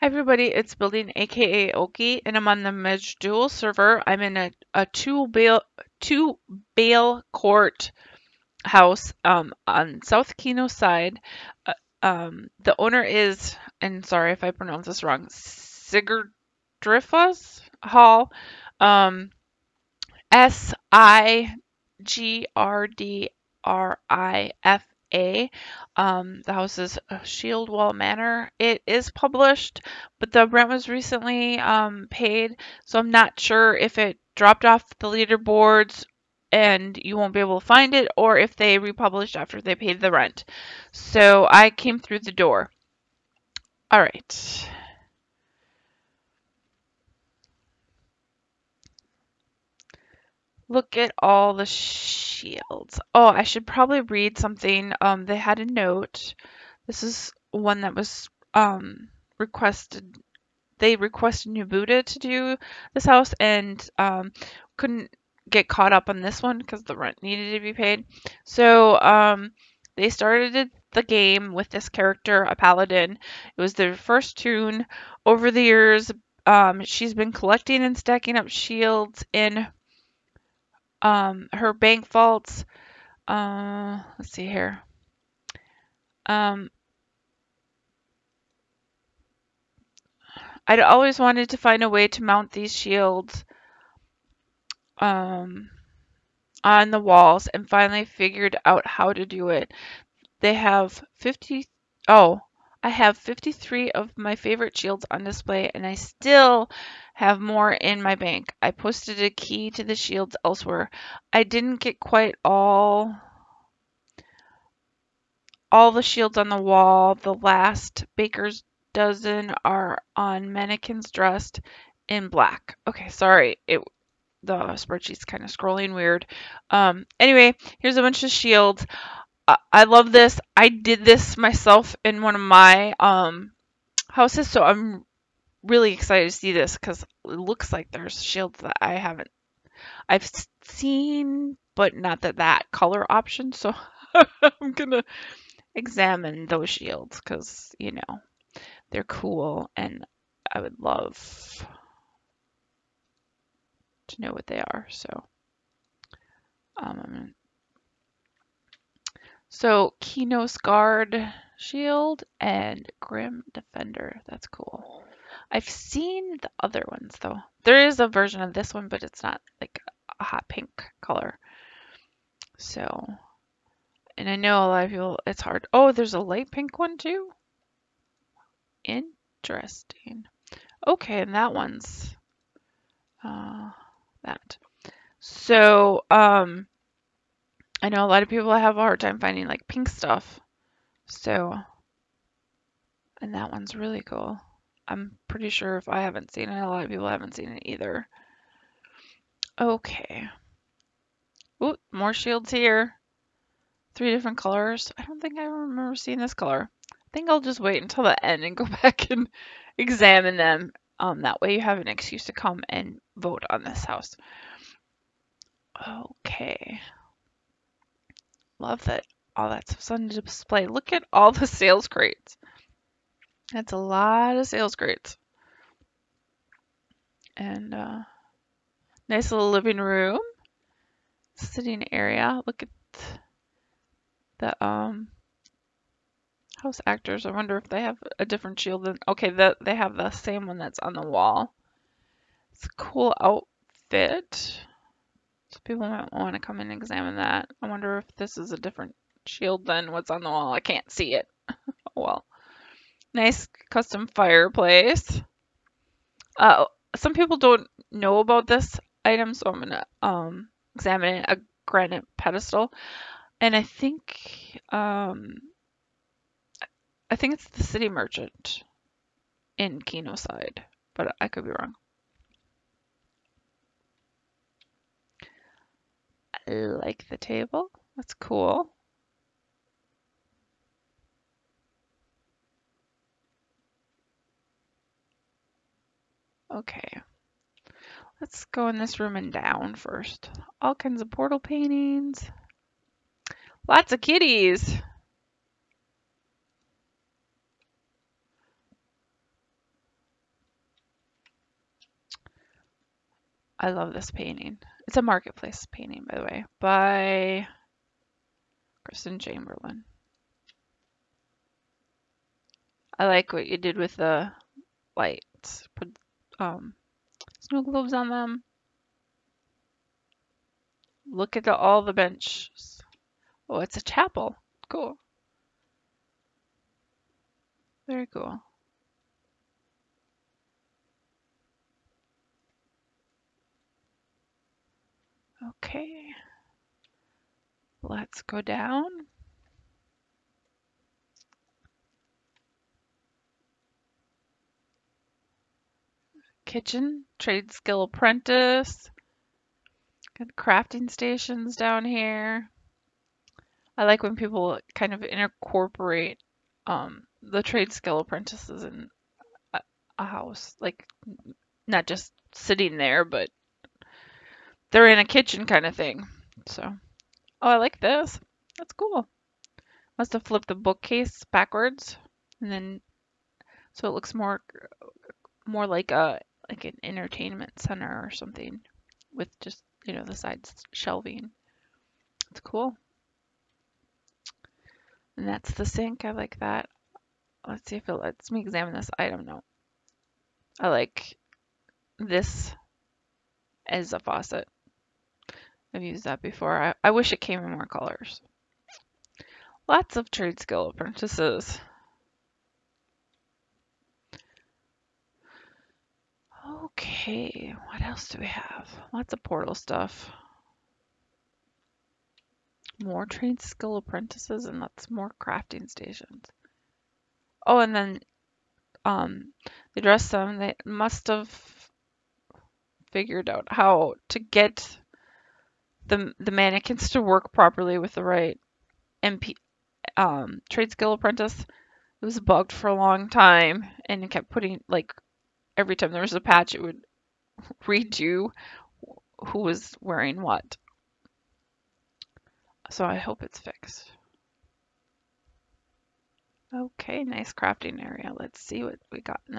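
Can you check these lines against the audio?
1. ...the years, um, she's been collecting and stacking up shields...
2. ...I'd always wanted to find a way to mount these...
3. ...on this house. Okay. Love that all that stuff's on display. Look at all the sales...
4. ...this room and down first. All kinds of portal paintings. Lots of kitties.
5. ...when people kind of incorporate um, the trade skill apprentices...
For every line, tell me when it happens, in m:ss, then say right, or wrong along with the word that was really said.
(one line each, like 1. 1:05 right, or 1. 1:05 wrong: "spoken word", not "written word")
1. 1:15 right
2. 1:30 right
3. 3:33 right
4. 4:48 right
5. 5:54 right.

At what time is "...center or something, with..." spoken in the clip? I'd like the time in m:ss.
6:17.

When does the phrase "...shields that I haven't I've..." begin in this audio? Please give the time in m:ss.
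2:18.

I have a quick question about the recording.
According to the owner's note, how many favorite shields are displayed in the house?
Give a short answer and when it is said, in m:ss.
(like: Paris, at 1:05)
53, at 1:43.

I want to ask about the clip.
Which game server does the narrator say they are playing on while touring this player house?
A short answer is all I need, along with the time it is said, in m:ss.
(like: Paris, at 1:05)
Maj'Dul, at 0:02.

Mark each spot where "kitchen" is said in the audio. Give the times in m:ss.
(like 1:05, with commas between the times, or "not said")
5:46, 6:05.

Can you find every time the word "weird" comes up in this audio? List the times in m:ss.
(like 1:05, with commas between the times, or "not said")
2:05.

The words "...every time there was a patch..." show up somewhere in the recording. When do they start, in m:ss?
7:15.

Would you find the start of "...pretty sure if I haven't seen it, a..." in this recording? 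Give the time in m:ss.
3:15.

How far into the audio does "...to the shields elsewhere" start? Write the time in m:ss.
1:49.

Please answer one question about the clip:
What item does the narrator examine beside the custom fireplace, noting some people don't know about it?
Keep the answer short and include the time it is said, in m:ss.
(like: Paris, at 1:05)
A granite pedestal, at 4:21.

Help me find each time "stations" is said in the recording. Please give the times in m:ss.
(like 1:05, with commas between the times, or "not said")
5:50, 6:55.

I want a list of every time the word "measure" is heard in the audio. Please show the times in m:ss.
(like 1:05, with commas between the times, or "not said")
not said.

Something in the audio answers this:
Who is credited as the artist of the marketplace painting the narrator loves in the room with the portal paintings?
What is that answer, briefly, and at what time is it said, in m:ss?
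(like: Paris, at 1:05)
Kristen Chamberlain, at 5:08.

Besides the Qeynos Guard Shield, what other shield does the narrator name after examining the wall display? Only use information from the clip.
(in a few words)
Grim Defender.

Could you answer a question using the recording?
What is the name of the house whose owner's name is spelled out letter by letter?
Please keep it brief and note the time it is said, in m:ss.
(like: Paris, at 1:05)
Shieldwall Manor, at 0:27.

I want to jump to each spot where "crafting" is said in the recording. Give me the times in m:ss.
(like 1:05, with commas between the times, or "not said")
5:50, 6:55, 7:27.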